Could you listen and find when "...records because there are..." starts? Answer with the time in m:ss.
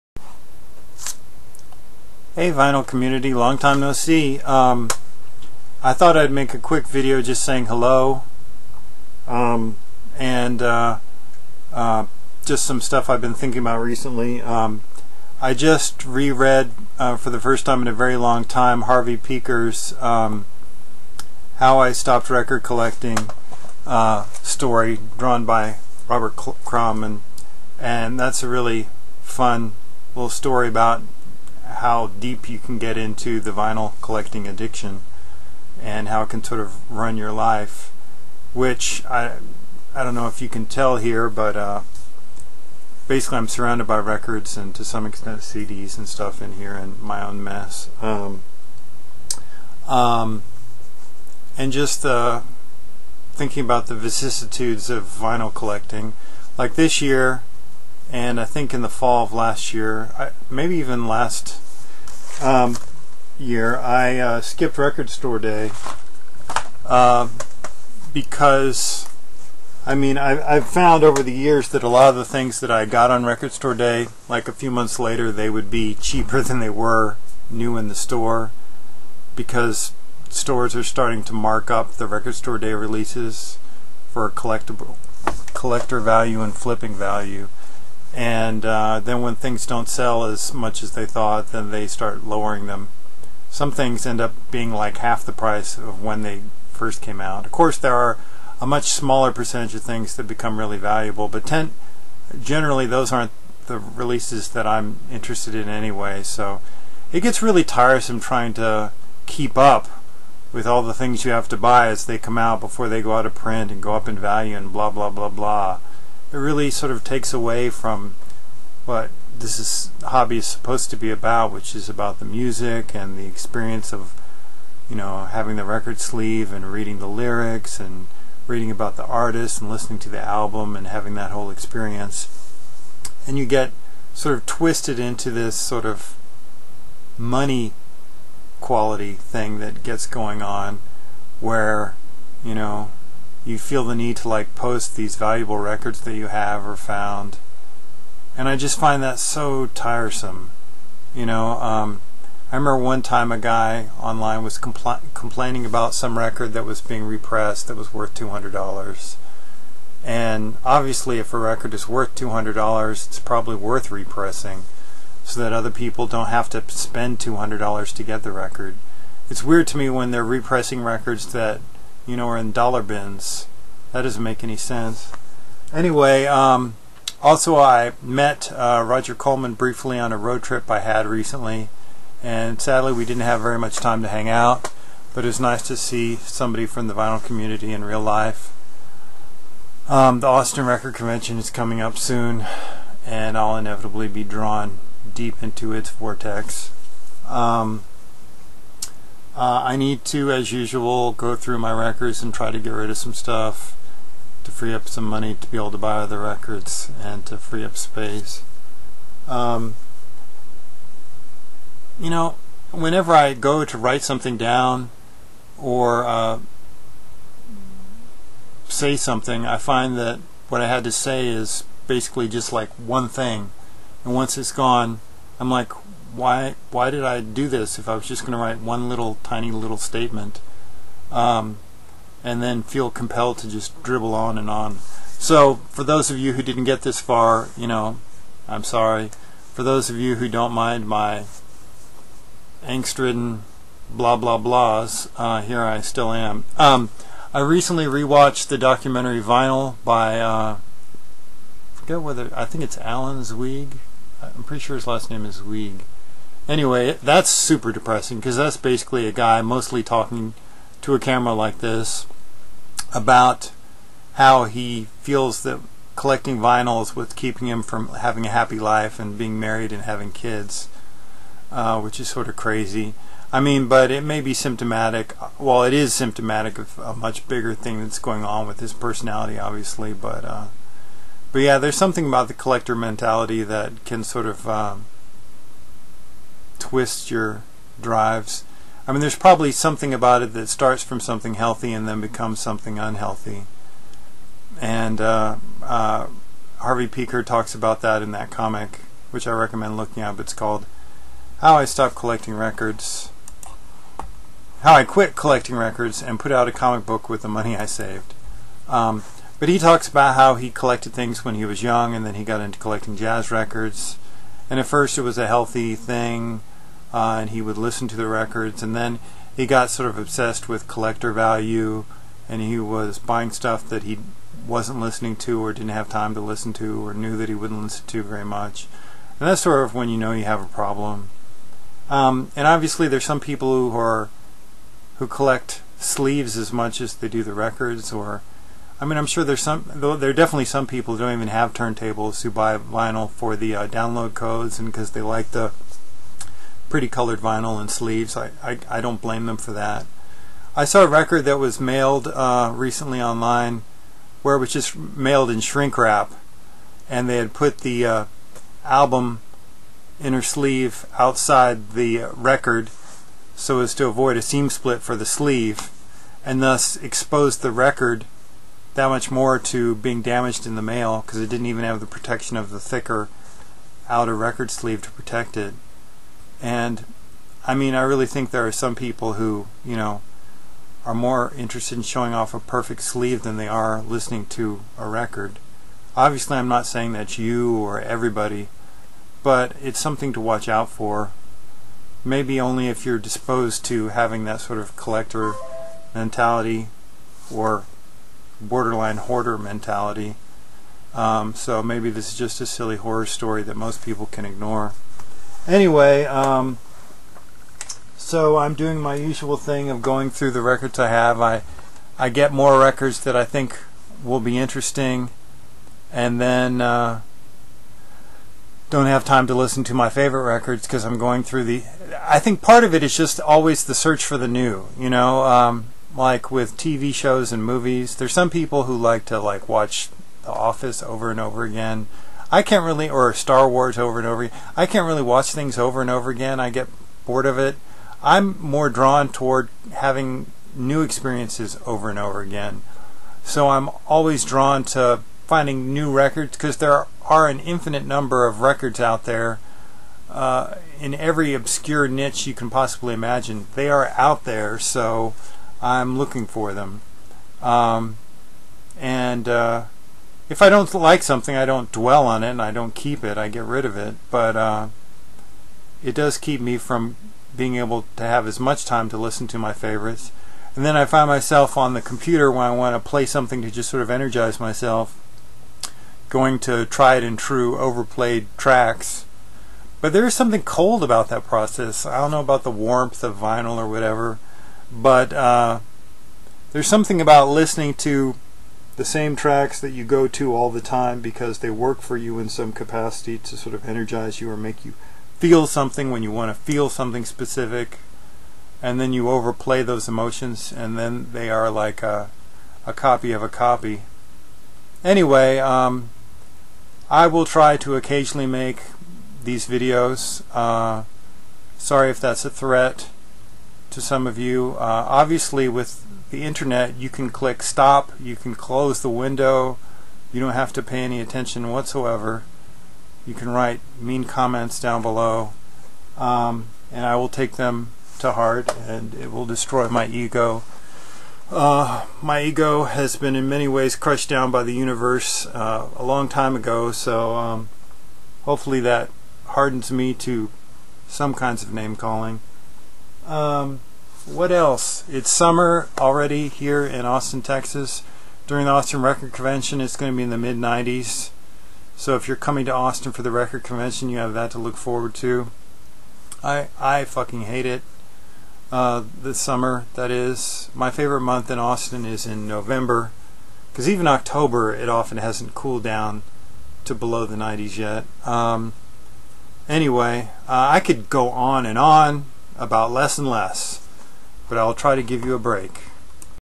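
7:25.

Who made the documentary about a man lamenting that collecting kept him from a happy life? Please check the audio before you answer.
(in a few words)
Alan Zweig.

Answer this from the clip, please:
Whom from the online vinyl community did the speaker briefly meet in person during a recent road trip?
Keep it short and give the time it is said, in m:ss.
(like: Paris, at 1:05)
Roger Coleman, at 2:58.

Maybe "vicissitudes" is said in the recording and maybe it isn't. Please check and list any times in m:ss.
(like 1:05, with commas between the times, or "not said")
0:53.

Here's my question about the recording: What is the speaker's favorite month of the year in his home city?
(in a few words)
November.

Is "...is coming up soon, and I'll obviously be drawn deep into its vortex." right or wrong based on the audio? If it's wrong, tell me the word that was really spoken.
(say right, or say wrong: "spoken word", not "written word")
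wrong: "inevitably", not "obviously".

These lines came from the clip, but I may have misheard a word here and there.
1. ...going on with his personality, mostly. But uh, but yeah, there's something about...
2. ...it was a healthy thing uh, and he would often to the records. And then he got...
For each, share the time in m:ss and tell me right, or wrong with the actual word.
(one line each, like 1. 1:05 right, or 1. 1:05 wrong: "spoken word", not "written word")
1. 4:37 wrong: "obviously", not "mostly"
2. 5:14 wrong: "listen", not "often".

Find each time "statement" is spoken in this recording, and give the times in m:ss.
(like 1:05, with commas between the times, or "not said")
3:49.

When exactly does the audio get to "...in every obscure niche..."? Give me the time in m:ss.
7:30.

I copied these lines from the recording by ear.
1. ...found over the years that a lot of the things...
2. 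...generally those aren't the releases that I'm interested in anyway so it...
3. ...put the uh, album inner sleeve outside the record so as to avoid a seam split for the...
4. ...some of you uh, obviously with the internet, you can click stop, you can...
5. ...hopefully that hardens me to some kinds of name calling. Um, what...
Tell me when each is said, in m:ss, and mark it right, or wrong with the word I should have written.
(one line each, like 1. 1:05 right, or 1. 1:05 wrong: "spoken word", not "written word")
1. 1:10 right
2. 1:42 right
3. 5:57 right
4. 8:33 right
5. 8:58 right.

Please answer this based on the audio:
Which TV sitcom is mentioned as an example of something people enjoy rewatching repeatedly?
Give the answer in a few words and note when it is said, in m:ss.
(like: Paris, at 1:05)
The Office, at 7:10.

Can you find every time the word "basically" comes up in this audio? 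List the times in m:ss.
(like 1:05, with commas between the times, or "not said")
0:43, 3:41, 4:18.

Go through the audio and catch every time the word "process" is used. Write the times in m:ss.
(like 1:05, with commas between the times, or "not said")
8:01.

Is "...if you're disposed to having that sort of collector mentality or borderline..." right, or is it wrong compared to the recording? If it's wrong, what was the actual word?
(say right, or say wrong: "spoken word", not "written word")
right.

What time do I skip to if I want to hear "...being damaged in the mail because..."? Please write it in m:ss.
6:09.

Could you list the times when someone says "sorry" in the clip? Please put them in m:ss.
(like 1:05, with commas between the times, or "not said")
3:58, 8:31.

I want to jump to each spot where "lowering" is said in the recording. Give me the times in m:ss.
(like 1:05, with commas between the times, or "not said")
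1:32.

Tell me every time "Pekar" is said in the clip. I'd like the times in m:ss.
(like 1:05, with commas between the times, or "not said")
0:19, 4:56.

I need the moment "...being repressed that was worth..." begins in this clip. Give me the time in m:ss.
2:36.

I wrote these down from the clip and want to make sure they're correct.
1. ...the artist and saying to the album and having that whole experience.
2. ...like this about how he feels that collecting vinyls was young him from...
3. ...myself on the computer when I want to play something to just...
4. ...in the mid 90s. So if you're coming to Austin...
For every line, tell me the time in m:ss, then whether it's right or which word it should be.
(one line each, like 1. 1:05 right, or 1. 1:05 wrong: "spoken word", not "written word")
1. 2:08 wrong: "listening", not "saying"
2. 4:21 wrong: "keeping", not "young"
3. 7:51 right
4. 9:10 right.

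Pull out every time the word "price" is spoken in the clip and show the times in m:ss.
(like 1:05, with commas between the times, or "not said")
1:35.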